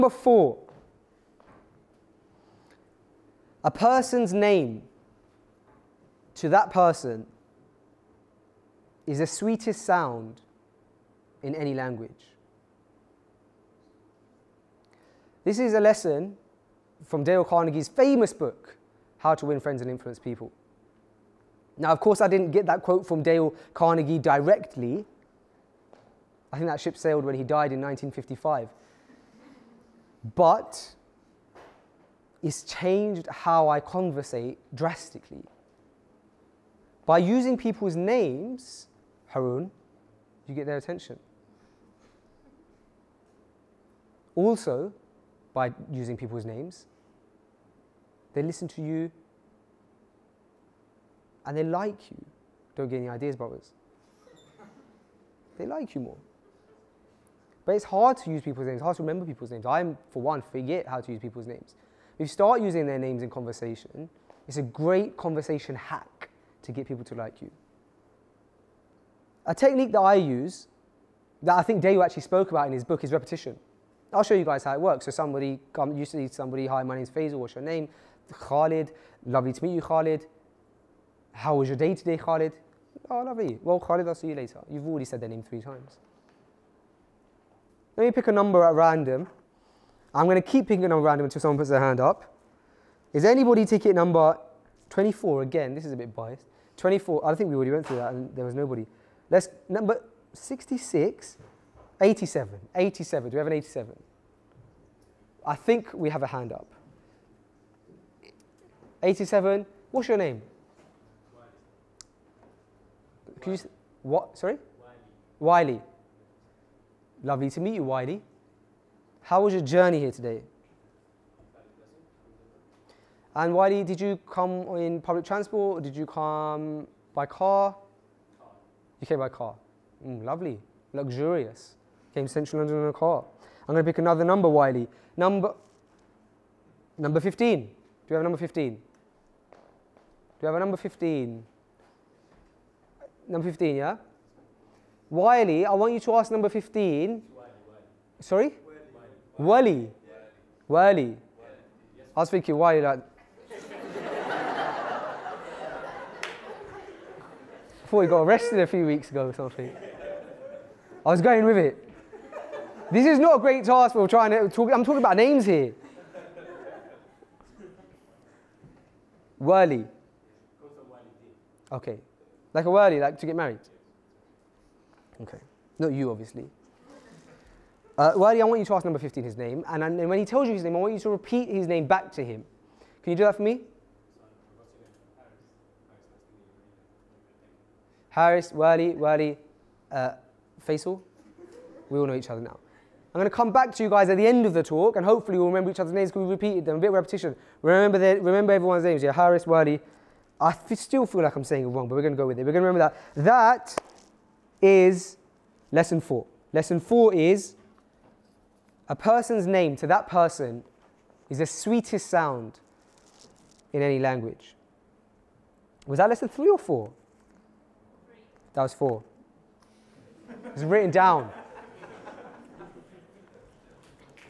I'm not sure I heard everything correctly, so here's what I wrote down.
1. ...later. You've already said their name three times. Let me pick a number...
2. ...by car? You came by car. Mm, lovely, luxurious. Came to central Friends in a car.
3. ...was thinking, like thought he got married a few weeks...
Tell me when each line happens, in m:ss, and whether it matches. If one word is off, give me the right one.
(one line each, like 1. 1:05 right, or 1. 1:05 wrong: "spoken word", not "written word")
1. 1:24 right
2. 2:07 wrong: "London", not "Friends"
3. 2:32 wrong: "arrested", not "married".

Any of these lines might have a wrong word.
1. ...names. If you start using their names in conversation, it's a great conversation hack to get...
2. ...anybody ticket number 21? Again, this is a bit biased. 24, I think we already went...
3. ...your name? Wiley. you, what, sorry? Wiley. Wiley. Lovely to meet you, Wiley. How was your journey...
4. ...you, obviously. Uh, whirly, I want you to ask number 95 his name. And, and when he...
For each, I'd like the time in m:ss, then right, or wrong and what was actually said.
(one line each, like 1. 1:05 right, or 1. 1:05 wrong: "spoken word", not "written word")
1. 1:01 right
2. 1:33 wrong: "24", not "21"
3. 1:50 right
4. 2:55 wrong: "15", not "95".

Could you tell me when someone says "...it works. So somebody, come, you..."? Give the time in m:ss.
1:14.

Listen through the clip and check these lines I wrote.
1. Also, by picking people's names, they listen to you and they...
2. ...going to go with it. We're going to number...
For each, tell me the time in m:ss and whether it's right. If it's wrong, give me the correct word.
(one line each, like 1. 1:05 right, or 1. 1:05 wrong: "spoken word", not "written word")
1. 0:44 wrong: "using", not "picking"
2. 3:22 wrong: "remember", not "number".